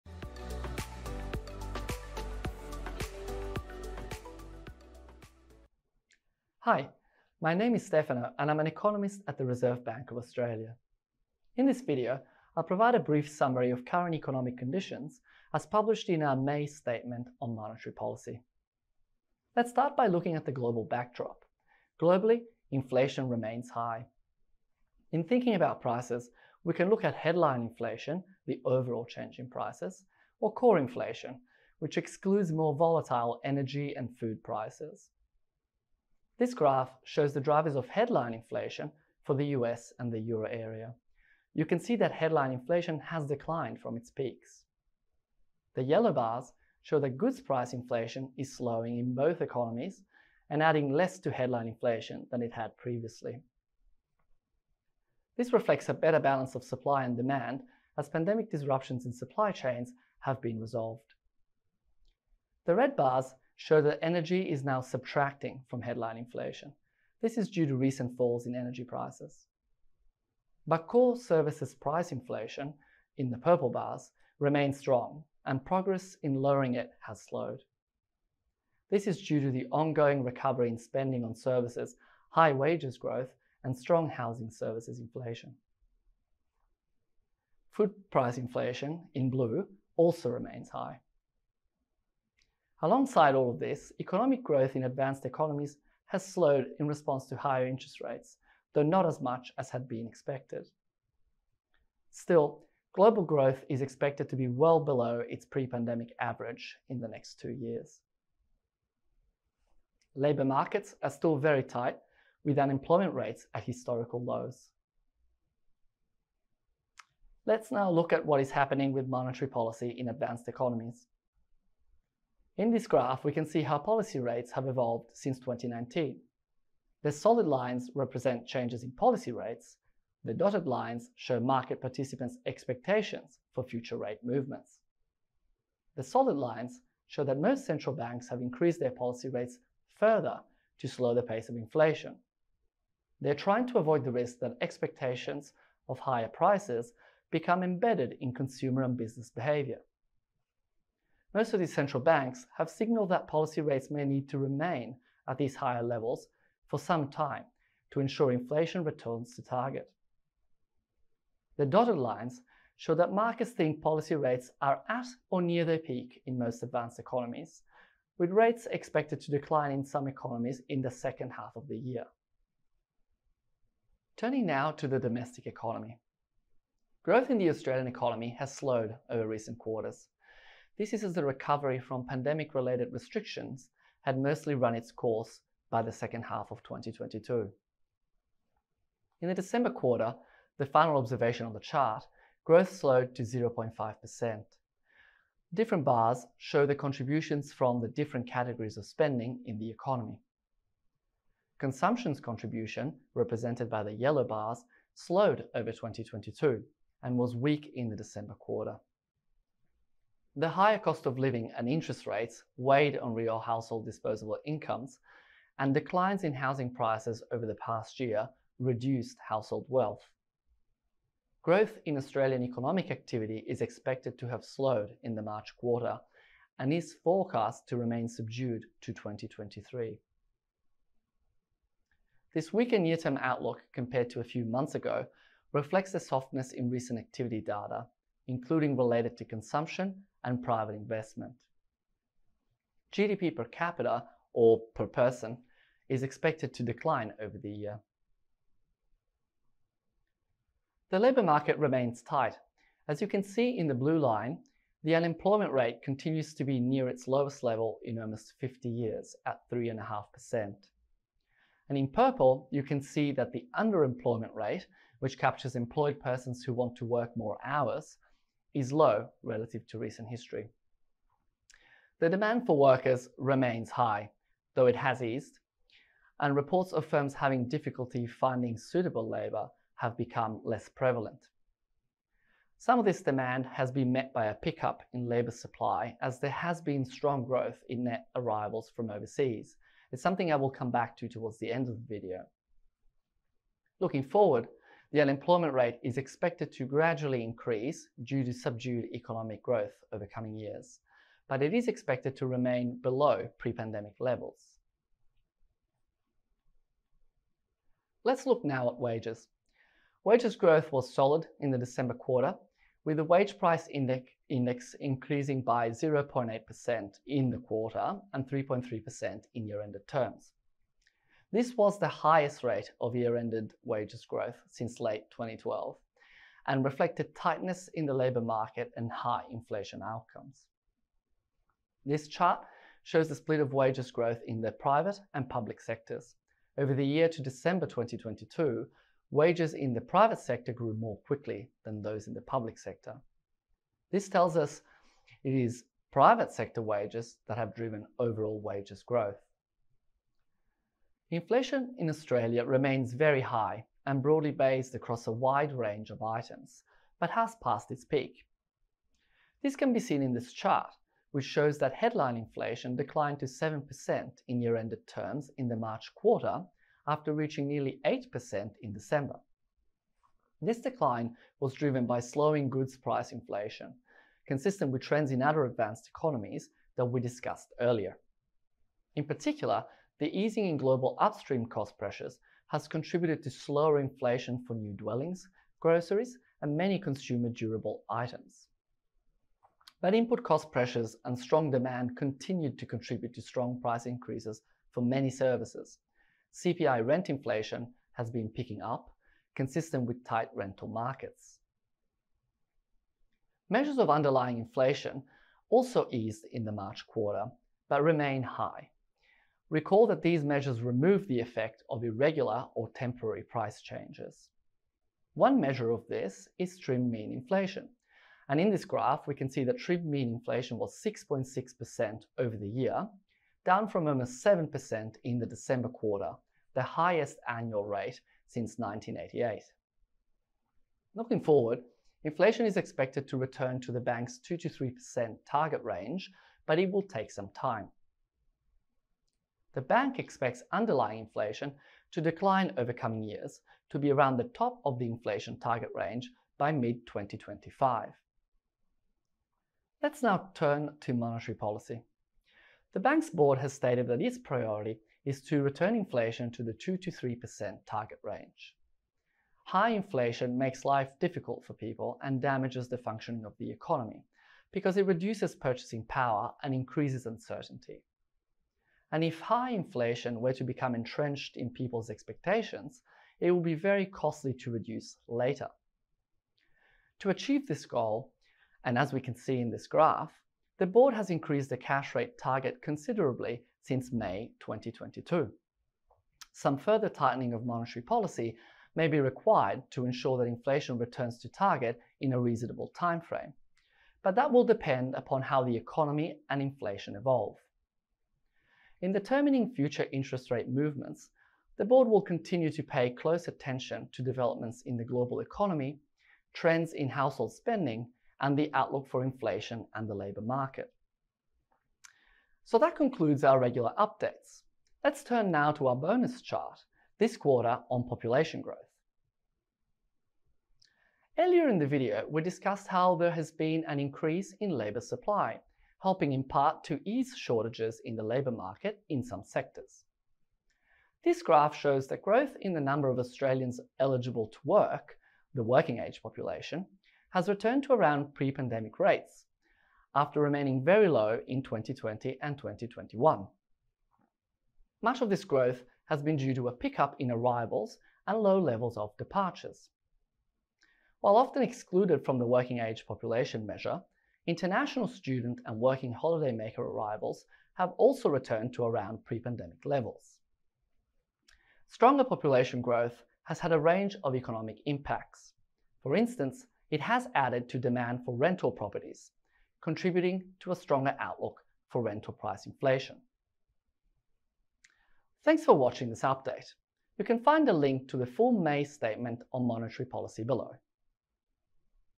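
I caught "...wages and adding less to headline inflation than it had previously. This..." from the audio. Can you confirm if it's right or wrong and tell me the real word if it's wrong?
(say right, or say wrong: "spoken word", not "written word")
wrong: "economies", not "wages".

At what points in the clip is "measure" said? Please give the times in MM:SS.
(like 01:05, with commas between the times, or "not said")
06:43, 06:50, 06:55, 09:13.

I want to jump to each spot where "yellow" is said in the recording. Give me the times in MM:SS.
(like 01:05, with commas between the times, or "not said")
00:45, 03:23.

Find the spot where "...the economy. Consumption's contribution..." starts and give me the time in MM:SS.
03:19.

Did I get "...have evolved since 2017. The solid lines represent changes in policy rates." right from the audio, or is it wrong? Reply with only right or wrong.
wrong.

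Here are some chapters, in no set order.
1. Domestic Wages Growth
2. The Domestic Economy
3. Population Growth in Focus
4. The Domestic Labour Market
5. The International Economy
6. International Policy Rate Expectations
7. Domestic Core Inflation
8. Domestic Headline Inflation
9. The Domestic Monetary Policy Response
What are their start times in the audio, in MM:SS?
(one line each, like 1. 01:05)
1. 05:07
2. 02:53
3. 08:40
4. 04:09
5. 00:19
6. 01:56
7. 06:43
8. 05:50
9. 07:29.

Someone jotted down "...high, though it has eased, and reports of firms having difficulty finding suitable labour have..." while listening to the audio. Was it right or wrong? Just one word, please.
right.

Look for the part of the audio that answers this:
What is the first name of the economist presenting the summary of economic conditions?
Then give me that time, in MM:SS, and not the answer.
00:07.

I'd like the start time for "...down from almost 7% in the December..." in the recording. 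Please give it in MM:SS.
07:03.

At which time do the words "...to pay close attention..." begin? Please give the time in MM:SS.
08:22.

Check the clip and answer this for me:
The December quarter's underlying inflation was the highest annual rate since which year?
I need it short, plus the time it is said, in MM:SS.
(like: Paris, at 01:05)
1988, at 07:08.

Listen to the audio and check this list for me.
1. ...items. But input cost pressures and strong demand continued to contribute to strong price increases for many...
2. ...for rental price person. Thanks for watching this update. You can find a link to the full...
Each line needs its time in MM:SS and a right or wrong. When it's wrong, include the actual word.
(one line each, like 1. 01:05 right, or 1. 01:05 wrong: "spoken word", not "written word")
1. 06:27 right
2. 09:31 wrong: "inflation", not "person".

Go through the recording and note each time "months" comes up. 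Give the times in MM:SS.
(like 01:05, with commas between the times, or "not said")
03:54.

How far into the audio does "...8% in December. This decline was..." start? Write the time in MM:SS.
06:07.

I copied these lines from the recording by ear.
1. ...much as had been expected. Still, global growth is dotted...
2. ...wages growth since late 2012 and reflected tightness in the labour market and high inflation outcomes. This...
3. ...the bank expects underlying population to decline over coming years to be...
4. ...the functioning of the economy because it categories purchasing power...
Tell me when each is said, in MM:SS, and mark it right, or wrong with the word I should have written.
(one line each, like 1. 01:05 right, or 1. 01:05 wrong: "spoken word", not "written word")
1. 01:39 wrong: "expected", not "dotted"
2. 05:23 right
3. 07:19 wrong: "inflation", not "population"
4. 07:42 wrong: "reduces", not "categories".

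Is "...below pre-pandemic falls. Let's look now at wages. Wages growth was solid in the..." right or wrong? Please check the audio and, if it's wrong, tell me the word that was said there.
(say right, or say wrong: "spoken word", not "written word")
wrong: "levels", not "falls".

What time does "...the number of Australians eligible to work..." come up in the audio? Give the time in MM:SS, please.
08:52.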